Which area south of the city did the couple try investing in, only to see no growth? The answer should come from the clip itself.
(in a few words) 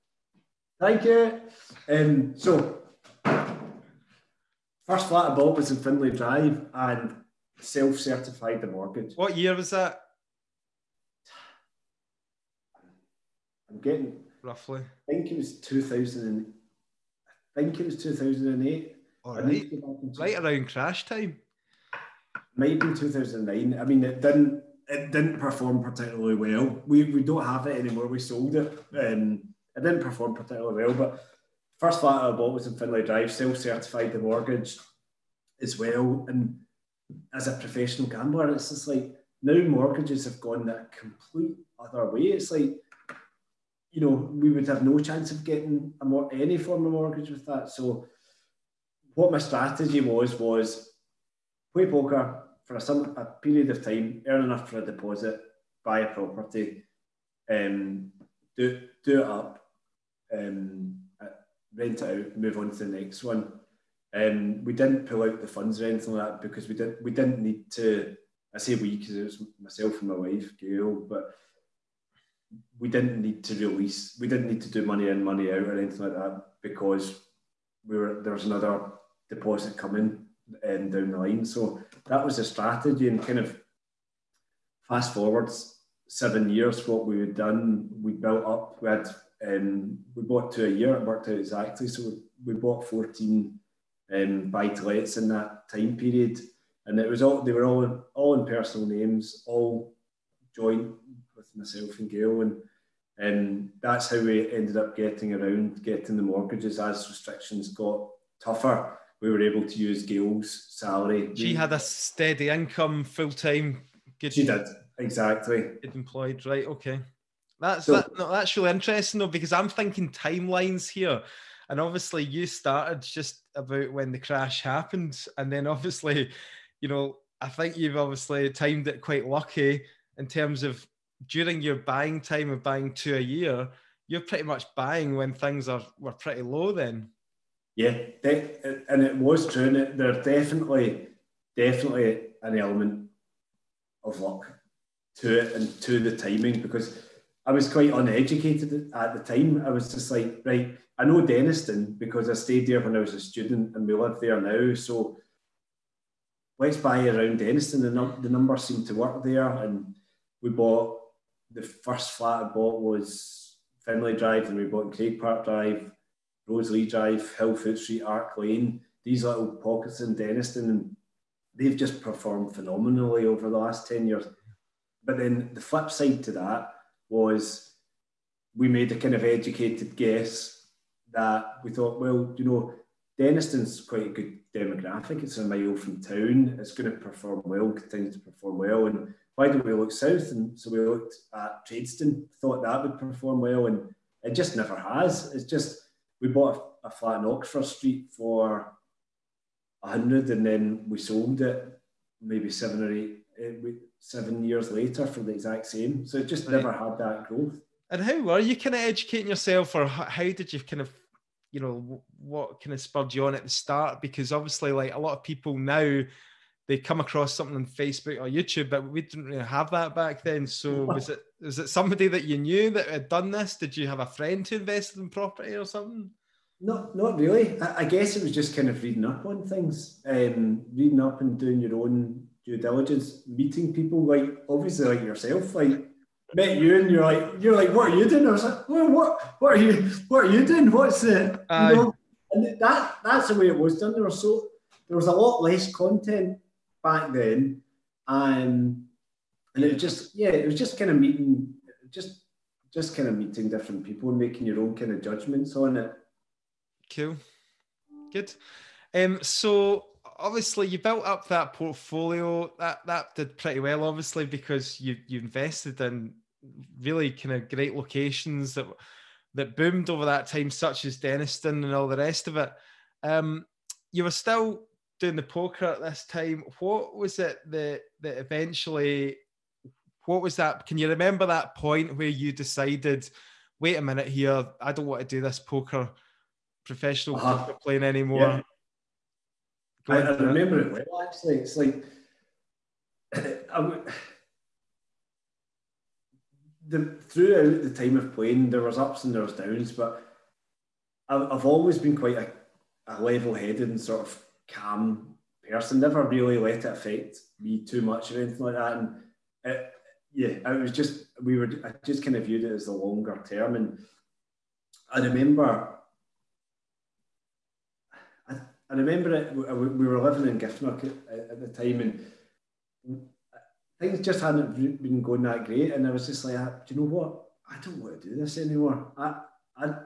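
Tradeston.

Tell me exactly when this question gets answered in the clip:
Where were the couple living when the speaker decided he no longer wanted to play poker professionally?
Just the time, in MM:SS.
05:20.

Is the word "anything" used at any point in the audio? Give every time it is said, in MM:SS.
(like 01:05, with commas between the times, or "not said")
01:05, 01:15, 05:08.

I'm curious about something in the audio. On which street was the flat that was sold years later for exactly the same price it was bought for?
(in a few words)
Oxford Street.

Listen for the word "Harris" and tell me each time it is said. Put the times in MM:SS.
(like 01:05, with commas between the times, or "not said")
not said.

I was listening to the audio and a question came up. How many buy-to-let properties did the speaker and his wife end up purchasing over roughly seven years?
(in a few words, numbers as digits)
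14.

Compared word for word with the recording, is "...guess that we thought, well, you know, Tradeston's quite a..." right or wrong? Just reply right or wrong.
wrong.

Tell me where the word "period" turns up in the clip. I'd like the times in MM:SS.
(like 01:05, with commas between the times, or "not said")
00:53, 01:35.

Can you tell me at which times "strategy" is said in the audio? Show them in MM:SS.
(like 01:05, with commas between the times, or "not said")
00:49, 01:22.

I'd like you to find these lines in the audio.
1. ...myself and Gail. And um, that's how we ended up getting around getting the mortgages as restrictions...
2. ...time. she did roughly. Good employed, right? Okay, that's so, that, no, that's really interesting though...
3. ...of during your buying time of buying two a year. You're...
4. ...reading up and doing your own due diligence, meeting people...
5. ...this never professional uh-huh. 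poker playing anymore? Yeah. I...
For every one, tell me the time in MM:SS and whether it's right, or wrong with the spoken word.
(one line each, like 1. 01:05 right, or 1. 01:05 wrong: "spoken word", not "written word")
1. 01:41 right
2. 01:53 wrong: "exactly", not "roughly"
3. 02:10 right
4. 03:50 right
5. 04:45 wrong: "poker", not "never".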